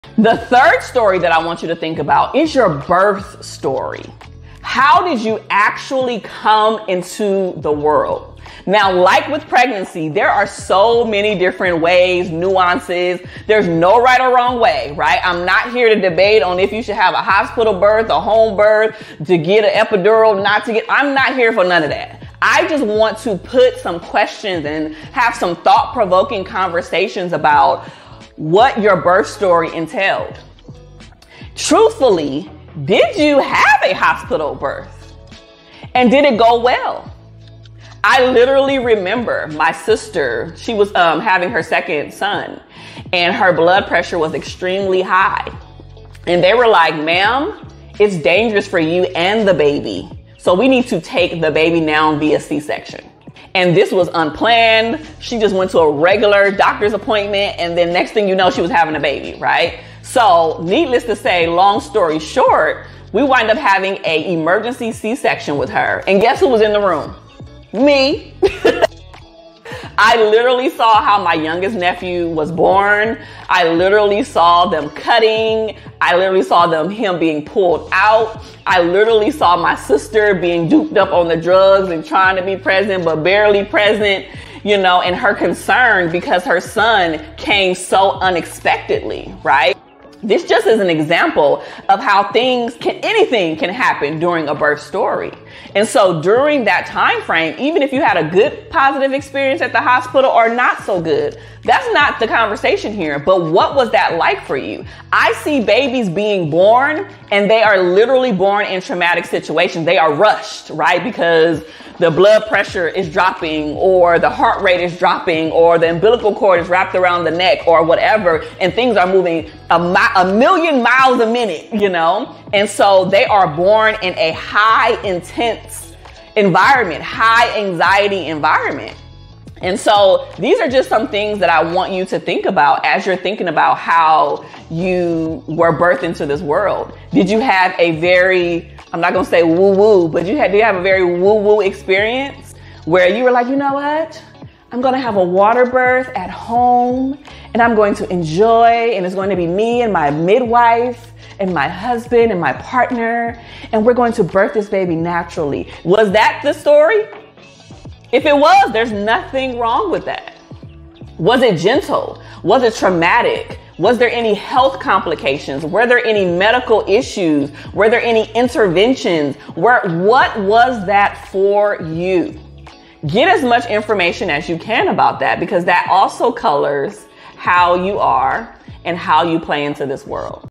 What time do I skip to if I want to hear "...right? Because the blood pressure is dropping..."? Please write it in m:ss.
1:50.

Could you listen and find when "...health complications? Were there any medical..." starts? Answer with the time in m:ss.
2:44.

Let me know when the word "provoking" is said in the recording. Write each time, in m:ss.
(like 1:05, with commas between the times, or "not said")
0:25.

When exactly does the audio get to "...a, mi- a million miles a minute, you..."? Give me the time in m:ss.
1:59.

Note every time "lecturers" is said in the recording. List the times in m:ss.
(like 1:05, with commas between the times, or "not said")
not said.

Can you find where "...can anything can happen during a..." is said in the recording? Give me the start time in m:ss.
1:32.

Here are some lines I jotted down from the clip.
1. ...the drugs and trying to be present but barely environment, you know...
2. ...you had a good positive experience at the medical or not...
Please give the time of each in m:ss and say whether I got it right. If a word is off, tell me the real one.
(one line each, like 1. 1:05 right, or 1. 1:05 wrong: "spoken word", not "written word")
1. 1:21 wrong: "present", not "environment"
2. 1:37 wrong: "hospital", not "medical".